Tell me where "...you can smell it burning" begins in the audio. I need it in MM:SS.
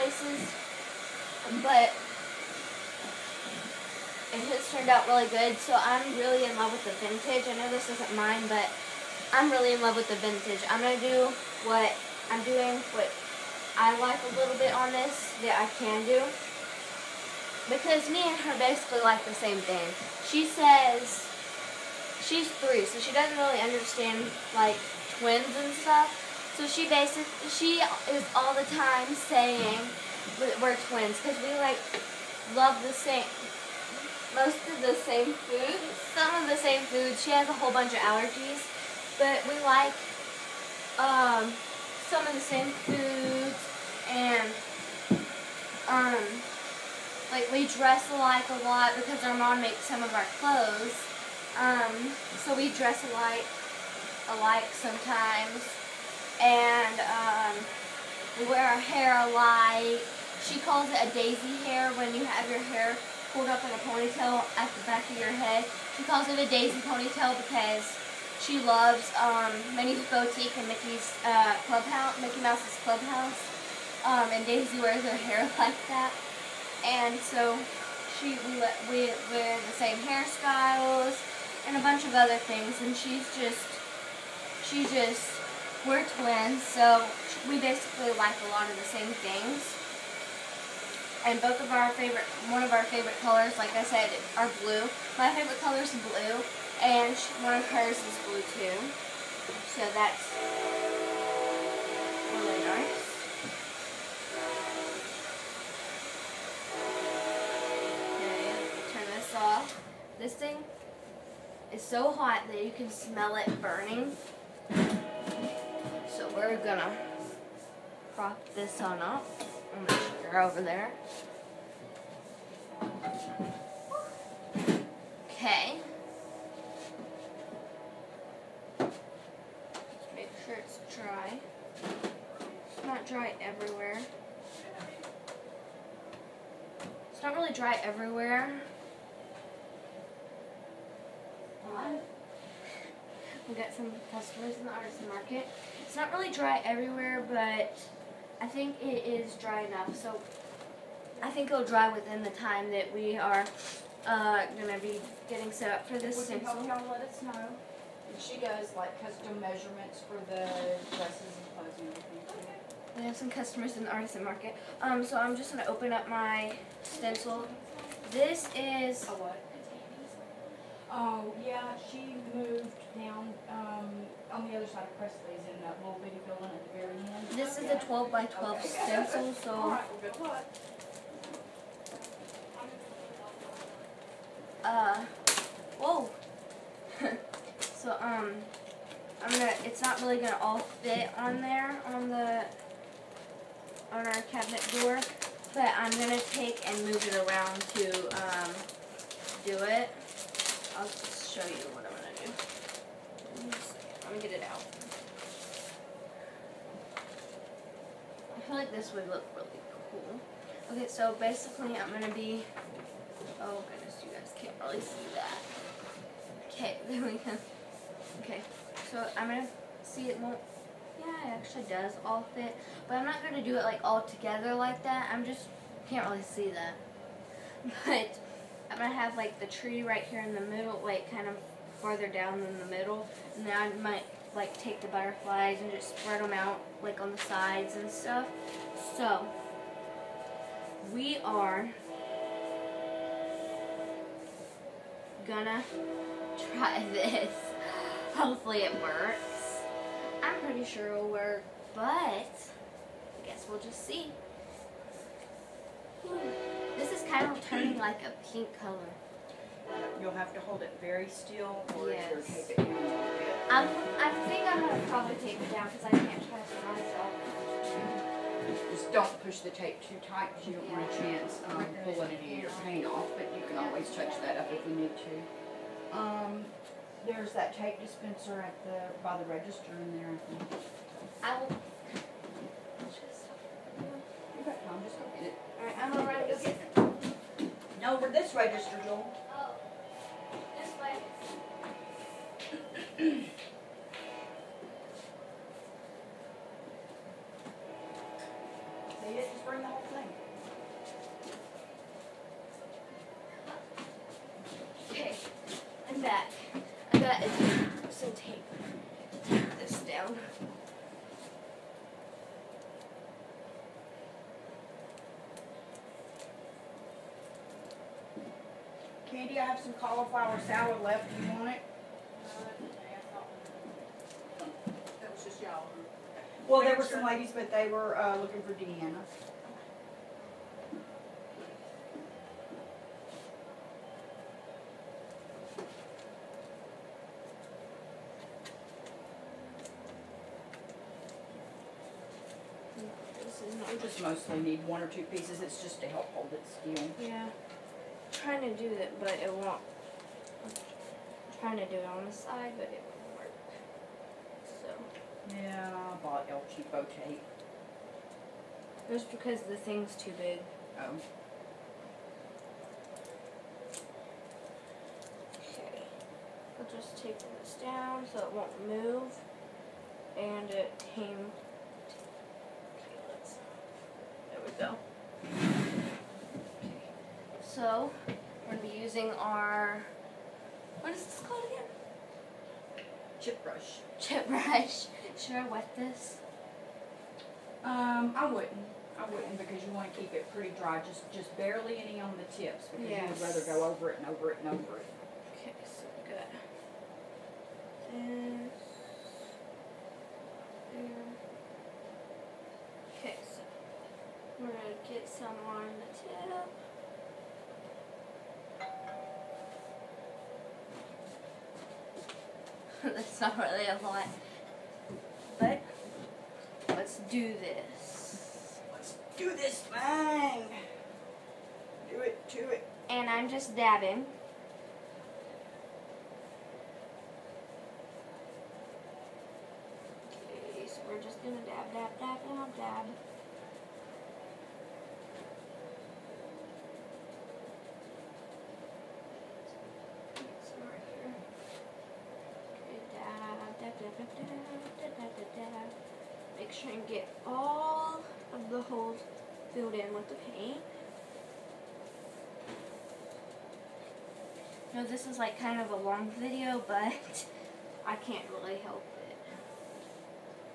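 01:52.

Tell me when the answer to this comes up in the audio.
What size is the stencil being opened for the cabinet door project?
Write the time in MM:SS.
02:57.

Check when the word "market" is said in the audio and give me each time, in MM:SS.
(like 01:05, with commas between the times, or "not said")
02:25, 02:44.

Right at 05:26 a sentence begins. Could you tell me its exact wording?
Well, there were some ladies, but they were uh, looking for Deanna.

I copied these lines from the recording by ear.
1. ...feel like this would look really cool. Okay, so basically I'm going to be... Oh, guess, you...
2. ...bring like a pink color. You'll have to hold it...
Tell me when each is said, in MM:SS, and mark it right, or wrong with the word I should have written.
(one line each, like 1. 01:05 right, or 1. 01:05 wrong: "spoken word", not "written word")
1. 03:28 wrong: "goodness", not "guess"
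2. 04:17 wrong: "turning", not "bring".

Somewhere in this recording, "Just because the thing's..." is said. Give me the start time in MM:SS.
05:58.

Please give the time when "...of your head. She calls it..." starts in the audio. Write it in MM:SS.
01:05.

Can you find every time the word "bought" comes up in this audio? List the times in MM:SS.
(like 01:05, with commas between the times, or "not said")
05:56.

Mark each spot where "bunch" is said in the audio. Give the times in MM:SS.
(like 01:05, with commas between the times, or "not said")
00:37, 01:21.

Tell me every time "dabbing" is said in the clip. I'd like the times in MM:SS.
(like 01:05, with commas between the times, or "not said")
07:03.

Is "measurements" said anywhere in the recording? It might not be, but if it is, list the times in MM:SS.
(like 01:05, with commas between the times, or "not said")
02:39.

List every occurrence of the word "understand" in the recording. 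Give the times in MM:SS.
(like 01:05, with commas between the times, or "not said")
00:23.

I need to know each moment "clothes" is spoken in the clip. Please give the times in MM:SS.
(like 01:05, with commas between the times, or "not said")
00:50, 02:41.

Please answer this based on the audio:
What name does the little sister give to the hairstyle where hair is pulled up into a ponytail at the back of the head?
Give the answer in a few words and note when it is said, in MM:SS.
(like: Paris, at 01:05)
daisy hair, at 01:01.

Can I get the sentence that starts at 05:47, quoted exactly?
Yeah trying to do it, but it won't.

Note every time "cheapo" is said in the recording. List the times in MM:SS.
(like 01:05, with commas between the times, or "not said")
05:56.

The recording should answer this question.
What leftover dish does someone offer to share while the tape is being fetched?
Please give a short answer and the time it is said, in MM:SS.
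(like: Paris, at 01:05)
cauliflower salad, at 05:19.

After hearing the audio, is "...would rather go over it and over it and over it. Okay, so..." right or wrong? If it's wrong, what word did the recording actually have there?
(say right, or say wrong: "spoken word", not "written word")
right.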